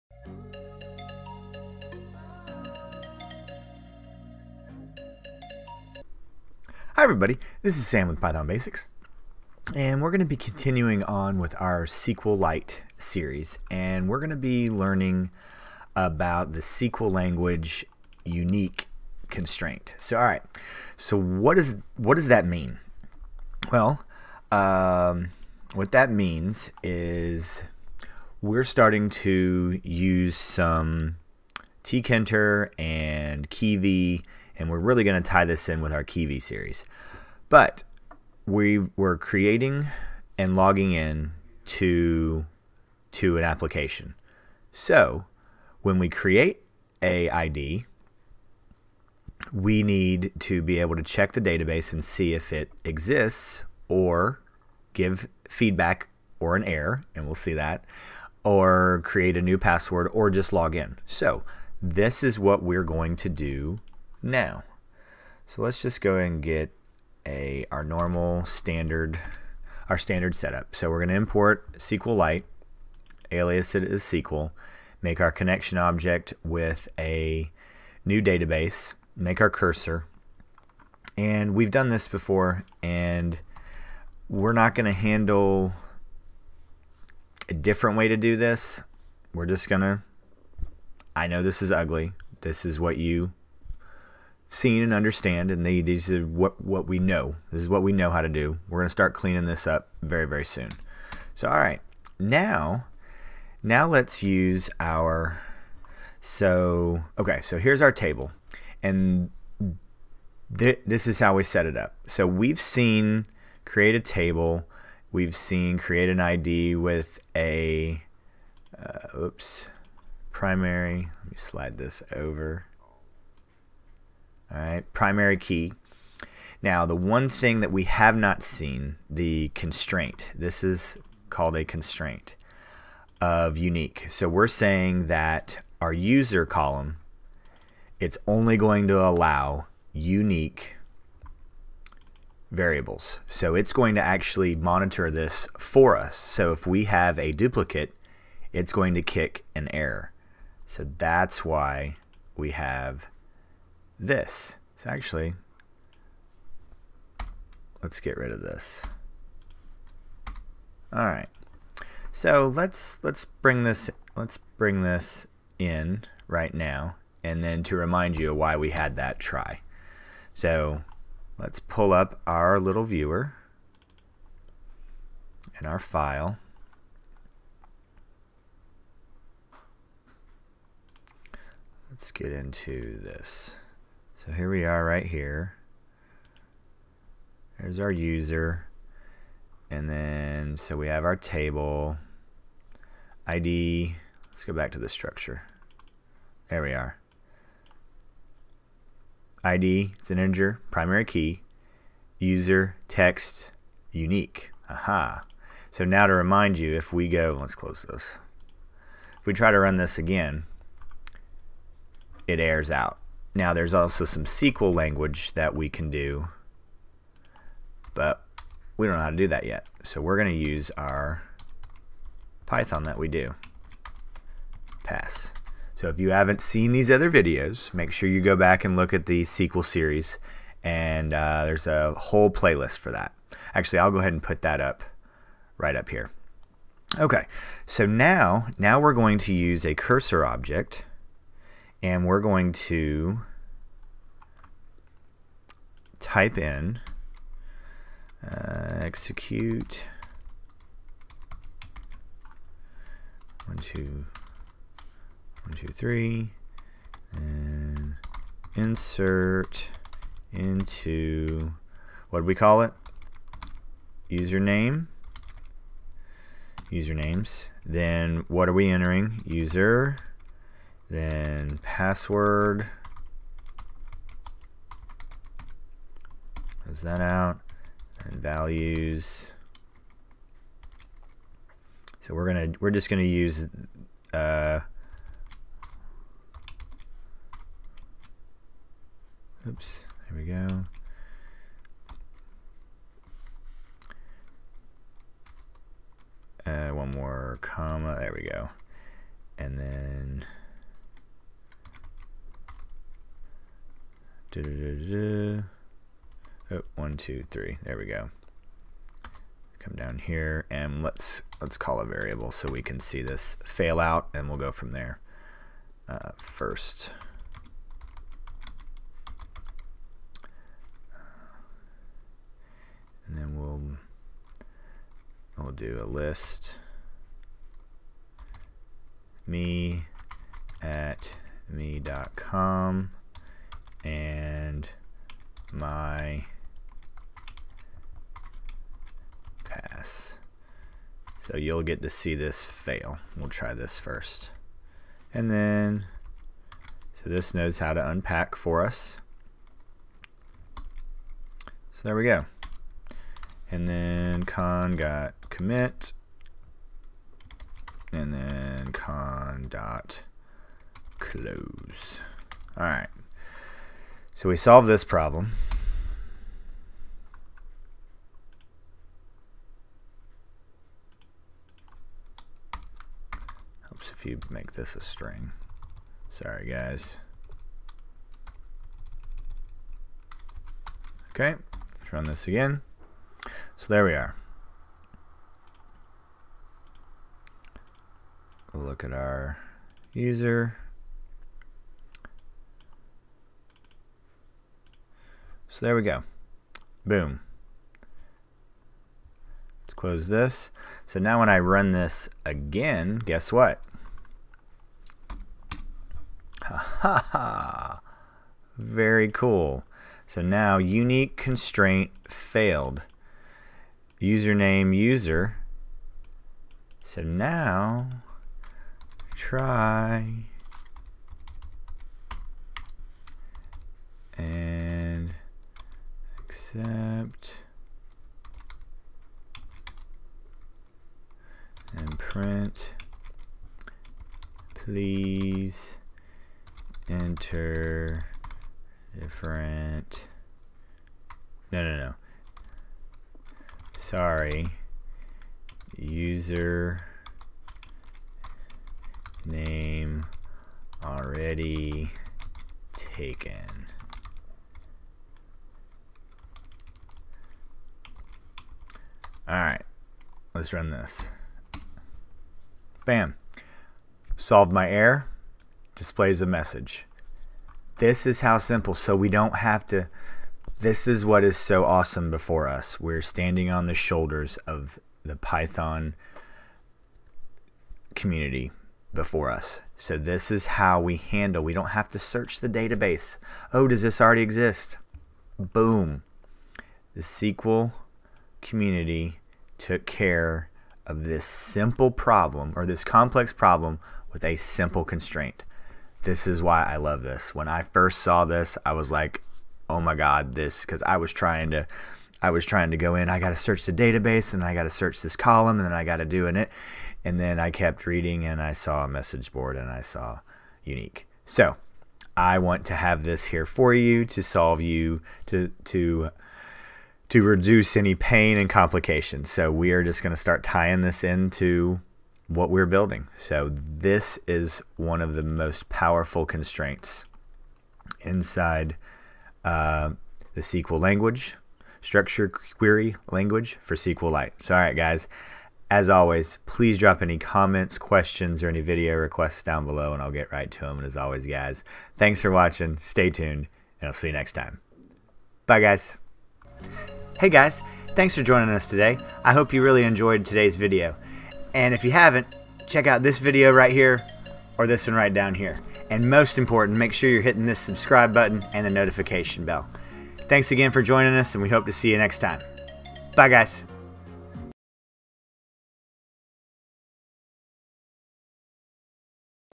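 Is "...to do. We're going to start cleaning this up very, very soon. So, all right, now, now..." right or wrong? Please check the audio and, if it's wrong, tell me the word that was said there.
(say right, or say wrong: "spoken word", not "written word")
right.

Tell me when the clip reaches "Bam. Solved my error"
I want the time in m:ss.
7:42.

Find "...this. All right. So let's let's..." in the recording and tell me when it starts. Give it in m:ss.
2:38.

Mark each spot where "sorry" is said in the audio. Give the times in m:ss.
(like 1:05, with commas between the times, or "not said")
6:16, 7:23.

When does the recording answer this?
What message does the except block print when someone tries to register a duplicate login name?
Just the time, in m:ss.
7:25.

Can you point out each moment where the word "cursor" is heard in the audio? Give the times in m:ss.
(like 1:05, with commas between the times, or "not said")
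1:19, 3:59.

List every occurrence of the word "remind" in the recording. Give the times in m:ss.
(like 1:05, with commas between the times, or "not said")
2:47, 3:26.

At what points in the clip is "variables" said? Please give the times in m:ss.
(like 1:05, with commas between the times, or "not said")
2:22, 5:11.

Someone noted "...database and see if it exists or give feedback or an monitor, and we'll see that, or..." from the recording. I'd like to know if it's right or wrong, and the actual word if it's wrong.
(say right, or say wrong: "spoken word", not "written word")
wrong: "error", not "monitor".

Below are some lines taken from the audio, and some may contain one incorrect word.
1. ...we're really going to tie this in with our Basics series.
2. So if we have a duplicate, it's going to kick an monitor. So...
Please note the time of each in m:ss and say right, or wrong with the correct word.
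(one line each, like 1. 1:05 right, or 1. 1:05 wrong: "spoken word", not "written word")
1. 0:34 wrong: "Kivy", not "Basics"
2. 2:26 wrong: "error", not "monitor".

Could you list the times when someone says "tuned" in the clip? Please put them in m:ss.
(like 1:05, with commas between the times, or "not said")
9:03.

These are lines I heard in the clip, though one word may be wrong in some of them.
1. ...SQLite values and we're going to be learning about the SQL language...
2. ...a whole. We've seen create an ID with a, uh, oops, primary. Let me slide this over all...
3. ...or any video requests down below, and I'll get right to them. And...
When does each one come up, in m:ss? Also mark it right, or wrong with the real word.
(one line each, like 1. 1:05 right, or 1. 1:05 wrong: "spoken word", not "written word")
1. 0:11 wrong: "series", not "values"
2. 1:53 wrong: "table", not "whole"
3. 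8:58 right.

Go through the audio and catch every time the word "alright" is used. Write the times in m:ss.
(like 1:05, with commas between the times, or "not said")
0:20, 7:39.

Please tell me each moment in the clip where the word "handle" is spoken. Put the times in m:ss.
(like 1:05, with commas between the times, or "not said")
1:24, 8:00.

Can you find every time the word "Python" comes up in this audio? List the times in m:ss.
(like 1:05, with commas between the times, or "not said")
0:08, 3:42, 7:55.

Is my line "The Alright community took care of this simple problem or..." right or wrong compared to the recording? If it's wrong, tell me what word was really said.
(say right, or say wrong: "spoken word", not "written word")
wrong: "SQL", not "Alright".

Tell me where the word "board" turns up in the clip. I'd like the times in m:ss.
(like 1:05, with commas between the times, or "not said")
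8:29.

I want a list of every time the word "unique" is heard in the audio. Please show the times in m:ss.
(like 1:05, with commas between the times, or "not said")
0:18, 2:13, 2:19, 3:23, 6:50, 8:30.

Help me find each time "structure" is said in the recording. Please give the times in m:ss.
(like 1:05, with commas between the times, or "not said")
3:14, 8:51.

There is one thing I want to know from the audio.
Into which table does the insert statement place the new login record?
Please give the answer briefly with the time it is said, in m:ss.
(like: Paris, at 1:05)
usernames, at 4:26.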